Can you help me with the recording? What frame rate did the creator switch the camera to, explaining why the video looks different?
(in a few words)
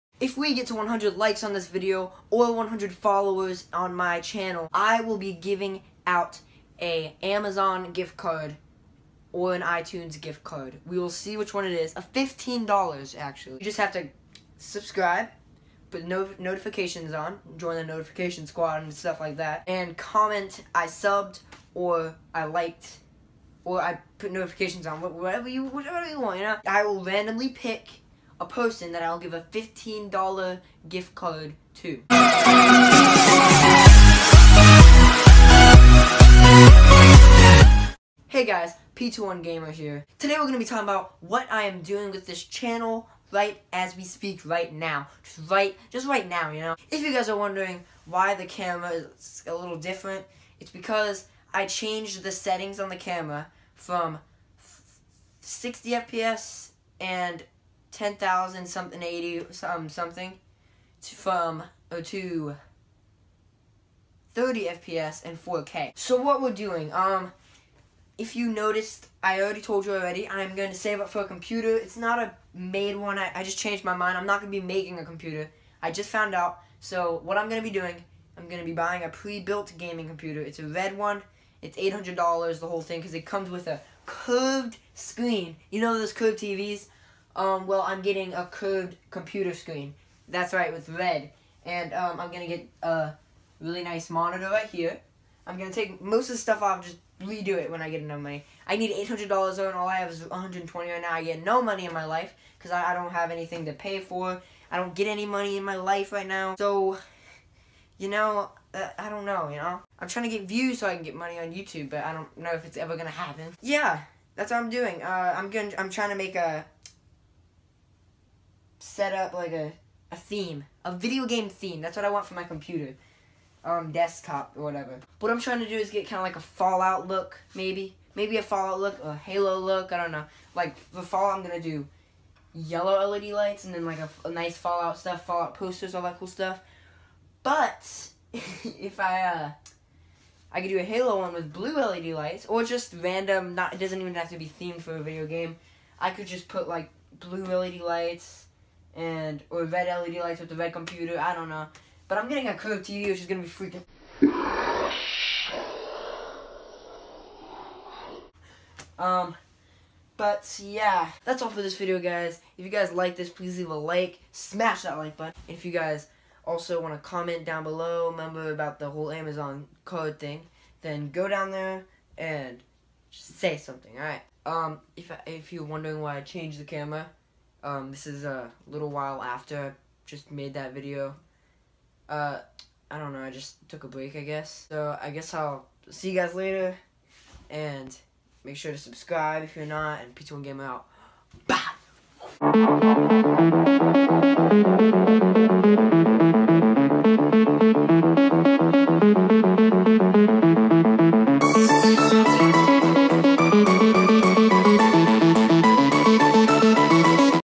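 30 FPS.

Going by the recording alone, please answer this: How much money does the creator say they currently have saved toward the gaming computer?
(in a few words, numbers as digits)
120.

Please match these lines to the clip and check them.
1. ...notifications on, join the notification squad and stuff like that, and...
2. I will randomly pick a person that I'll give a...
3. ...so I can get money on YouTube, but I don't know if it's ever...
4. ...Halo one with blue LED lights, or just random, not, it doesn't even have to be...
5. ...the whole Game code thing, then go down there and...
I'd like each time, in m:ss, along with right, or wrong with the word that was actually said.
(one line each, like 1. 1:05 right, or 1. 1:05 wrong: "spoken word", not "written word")
1. 0:16 right
2. 0:26 right
3. 1:50 right
4. 2:20 right
5. 2:48 wrong: "Amazon", not "Game".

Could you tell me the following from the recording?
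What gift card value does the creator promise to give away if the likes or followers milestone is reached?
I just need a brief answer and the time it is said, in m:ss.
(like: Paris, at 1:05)
$15, at 0:11.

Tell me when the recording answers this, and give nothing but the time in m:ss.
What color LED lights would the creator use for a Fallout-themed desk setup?
2:12.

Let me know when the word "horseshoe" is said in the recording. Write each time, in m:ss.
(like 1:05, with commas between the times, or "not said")
not said.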